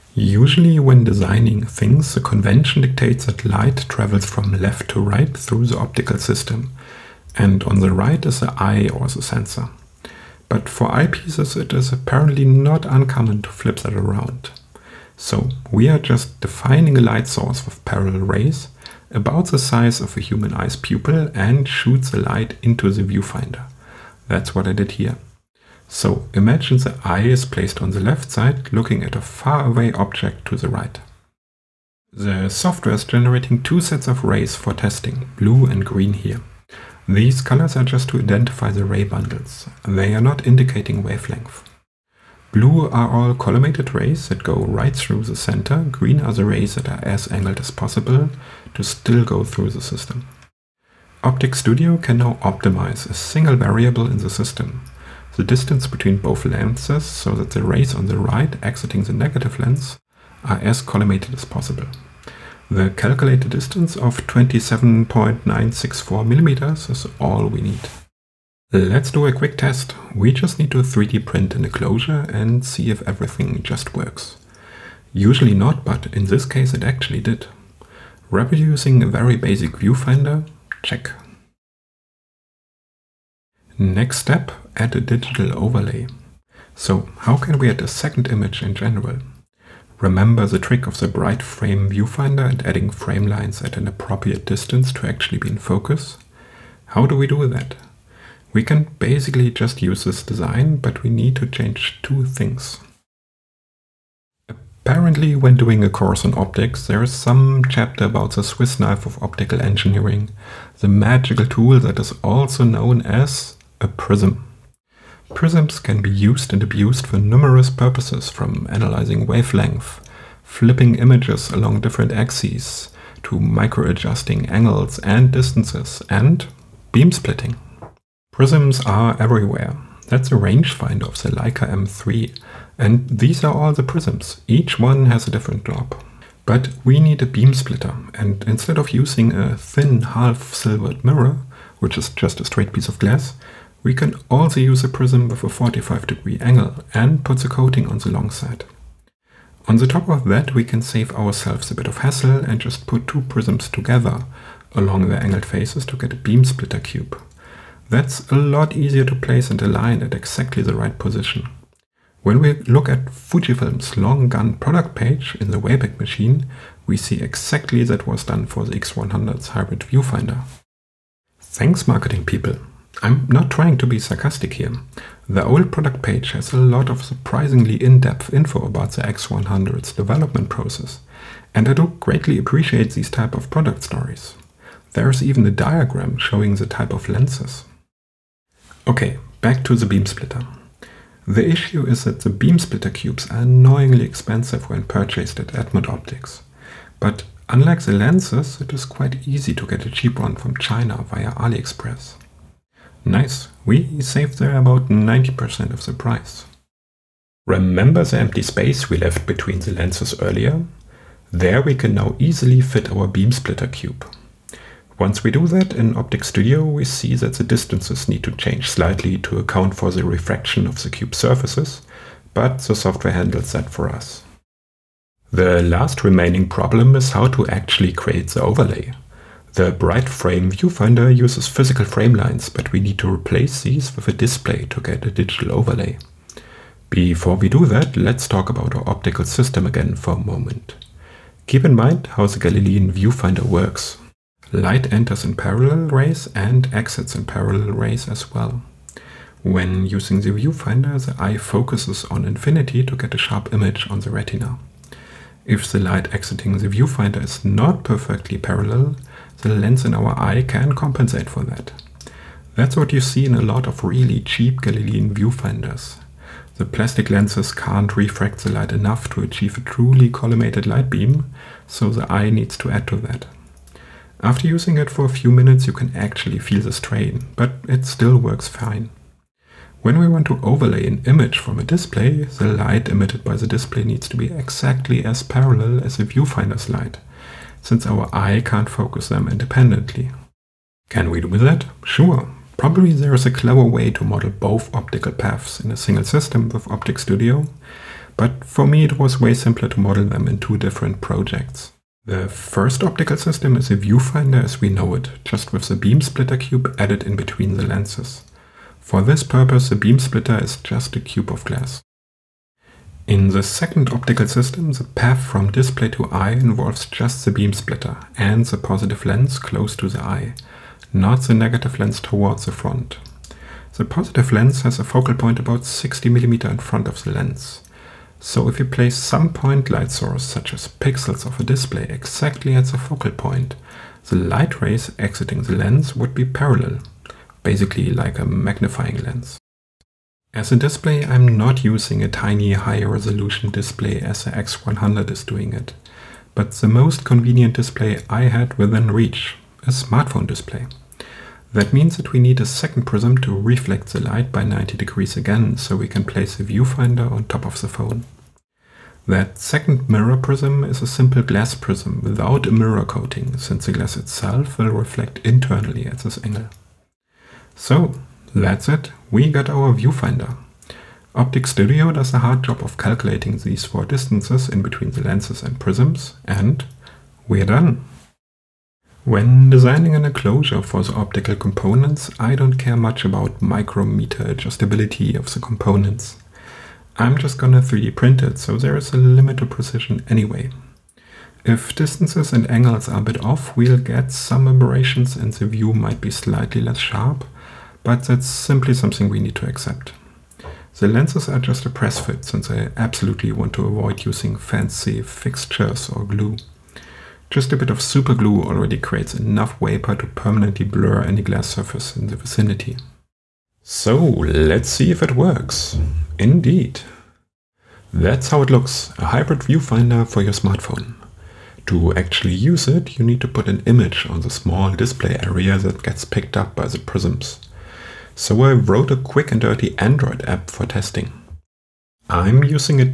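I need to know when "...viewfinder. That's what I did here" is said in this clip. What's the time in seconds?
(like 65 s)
23 s.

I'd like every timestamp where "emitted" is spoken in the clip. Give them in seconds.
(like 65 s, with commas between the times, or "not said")
282 s.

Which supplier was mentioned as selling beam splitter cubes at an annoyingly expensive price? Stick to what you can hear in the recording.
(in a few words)
Edmund Optics.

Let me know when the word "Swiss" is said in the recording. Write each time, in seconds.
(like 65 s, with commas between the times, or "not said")
108 s.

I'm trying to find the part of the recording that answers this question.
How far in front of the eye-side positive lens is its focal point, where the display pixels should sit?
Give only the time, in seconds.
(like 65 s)
325 s.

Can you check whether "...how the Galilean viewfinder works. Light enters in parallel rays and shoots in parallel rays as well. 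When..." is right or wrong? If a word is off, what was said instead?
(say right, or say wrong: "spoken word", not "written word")
wrong: "exits", not "shoots".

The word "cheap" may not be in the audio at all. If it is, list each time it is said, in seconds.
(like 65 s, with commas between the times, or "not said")
199 s, 264 s.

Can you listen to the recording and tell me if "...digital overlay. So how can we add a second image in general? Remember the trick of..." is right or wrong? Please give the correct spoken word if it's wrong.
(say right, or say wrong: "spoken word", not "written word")
right.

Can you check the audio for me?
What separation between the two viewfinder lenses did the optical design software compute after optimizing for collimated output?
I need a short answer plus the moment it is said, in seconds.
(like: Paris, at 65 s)
27.964 millimeters, at 64 s.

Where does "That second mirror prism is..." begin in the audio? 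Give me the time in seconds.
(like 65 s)
359 s.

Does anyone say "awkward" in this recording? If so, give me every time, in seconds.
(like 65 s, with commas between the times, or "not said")
not said.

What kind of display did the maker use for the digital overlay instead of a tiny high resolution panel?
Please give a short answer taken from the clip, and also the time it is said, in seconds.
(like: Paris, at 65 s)
smartphone display, at 349 s.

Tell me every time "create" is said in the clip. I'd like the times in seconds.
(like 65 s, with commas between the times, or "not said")
227 s, 408 s.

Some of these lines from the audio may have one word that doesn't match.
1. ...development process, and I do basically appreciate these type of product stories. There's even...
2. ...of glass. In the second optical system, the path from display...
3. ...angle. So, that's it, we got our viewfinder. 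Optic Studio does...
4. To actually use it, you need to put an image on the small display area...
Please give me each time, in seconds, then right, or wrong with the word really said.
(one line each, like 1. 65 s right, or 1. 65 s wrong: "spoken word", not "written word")
1. 179 s wrong: "greatly", not "basically"
2. 311 s right
3. 366 s right
4. 421 s right.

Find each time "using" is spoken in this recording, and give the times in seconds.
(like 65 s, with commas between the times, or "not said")
138 s, 249 s, 274 s, 341 s, 404 s, 432 s.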